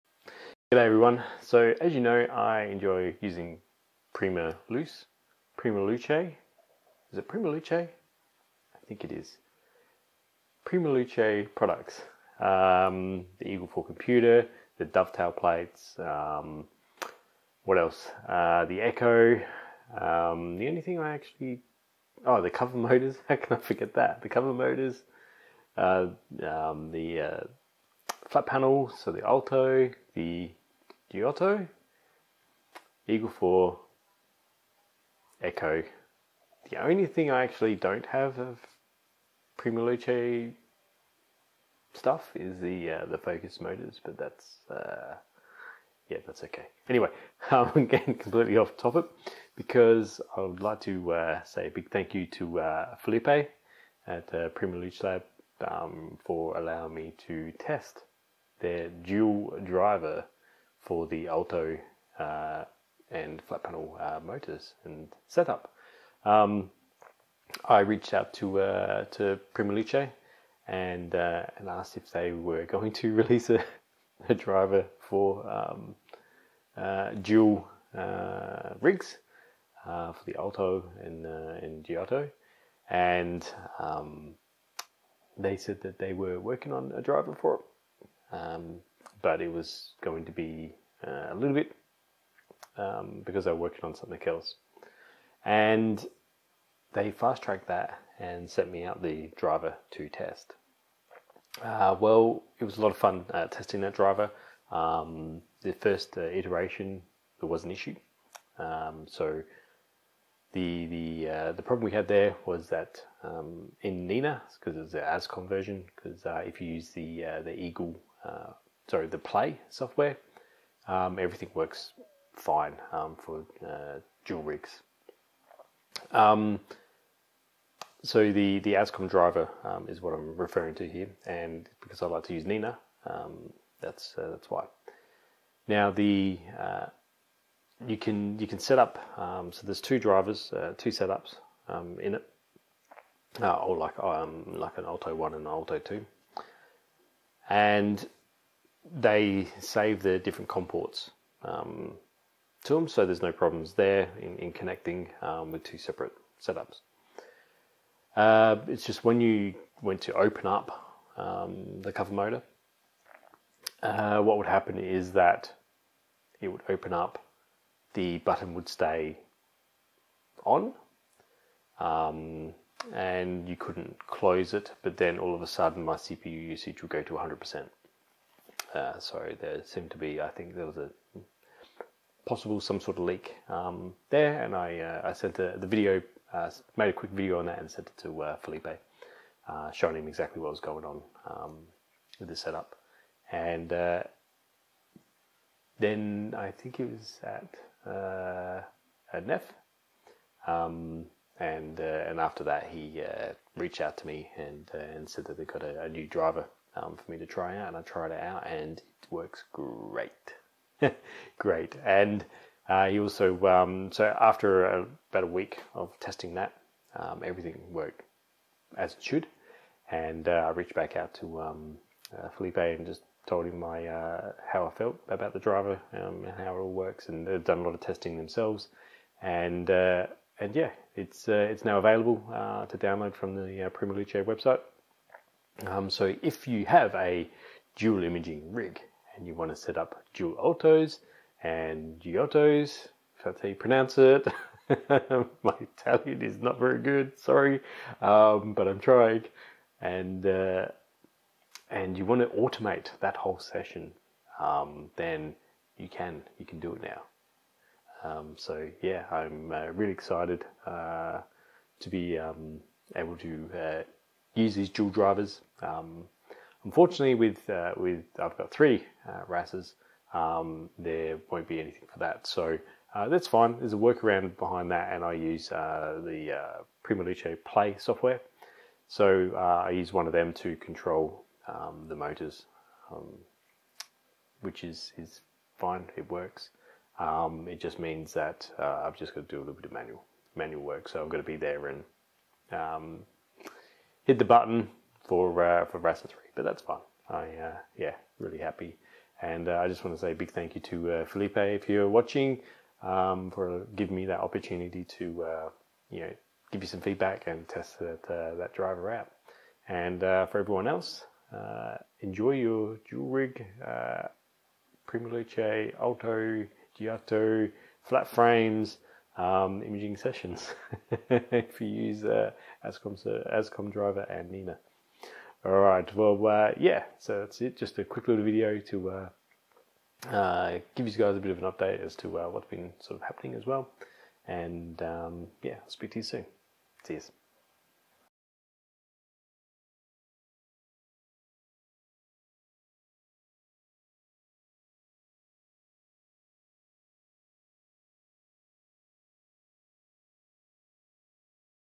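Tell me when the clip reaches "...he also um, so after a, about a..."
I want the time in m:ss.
3:32.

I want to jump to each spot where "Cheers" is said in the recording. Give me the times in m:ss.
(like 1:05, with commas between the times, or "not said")
5:36.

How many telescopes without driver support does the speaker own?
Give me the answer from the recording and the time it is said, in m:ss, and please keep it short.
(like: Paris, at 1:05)
3, at 4:28.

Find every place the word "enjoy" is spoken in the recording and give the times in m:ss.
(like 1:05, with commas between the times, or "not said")
0:02, 5:12.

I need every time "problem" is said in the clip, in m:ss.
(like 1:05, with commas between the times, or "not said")
1:51, 2:33.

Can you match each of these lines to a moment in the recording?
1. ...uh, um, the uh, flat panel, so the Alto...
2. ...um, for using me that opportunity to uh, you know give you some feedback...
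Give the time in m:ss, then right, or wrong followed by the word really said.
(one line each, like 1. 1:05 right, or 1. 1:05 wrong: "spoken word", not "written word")
1. 0:25 right
2. 5:02 wrong: "giving", not "using".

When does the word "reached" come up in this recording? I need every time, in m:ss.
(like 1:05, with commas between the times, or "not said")
1:07, 3:23, 3:40.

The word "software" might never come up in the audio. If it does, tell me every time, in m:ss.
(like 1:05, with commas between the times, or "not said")
1:59, 4:37.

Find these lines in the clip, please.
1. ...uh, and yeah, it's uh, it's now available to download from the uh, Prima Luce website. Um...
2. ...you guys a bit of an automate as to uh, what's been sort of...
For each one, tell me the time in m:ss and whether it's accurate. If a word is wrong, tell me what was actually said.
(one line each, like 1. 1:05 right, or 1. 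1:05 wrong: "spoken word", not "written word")
1. 3:49 right
2. 5:30 wrong: "update", not "automate".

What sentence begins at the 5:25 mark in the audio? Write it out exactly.
All right, well, uh, yeah, so that's it.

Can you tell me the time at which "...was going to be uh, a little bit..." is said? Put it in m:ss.
1:29.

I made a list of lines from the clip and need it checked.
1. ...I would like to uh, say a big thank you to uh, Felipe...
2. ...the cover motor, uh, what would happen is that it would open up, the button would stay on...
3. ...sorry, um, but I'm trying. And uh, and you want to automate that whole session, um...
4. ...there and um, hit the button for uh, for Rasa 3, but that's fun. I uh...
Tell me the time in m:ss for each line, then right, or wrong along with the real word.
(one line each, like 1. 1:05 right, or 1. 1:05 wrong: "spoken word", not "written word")
1. 0:50 right
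2. 2:41 right
3. 4:07 right
4. 4:51 right.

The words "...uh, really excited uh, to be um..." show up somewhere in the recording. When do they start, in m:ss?
4:19.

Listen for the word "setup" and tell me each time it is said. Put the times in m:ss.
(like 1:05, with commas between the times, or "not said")
1:05, 2:20, 2:36, 3:12.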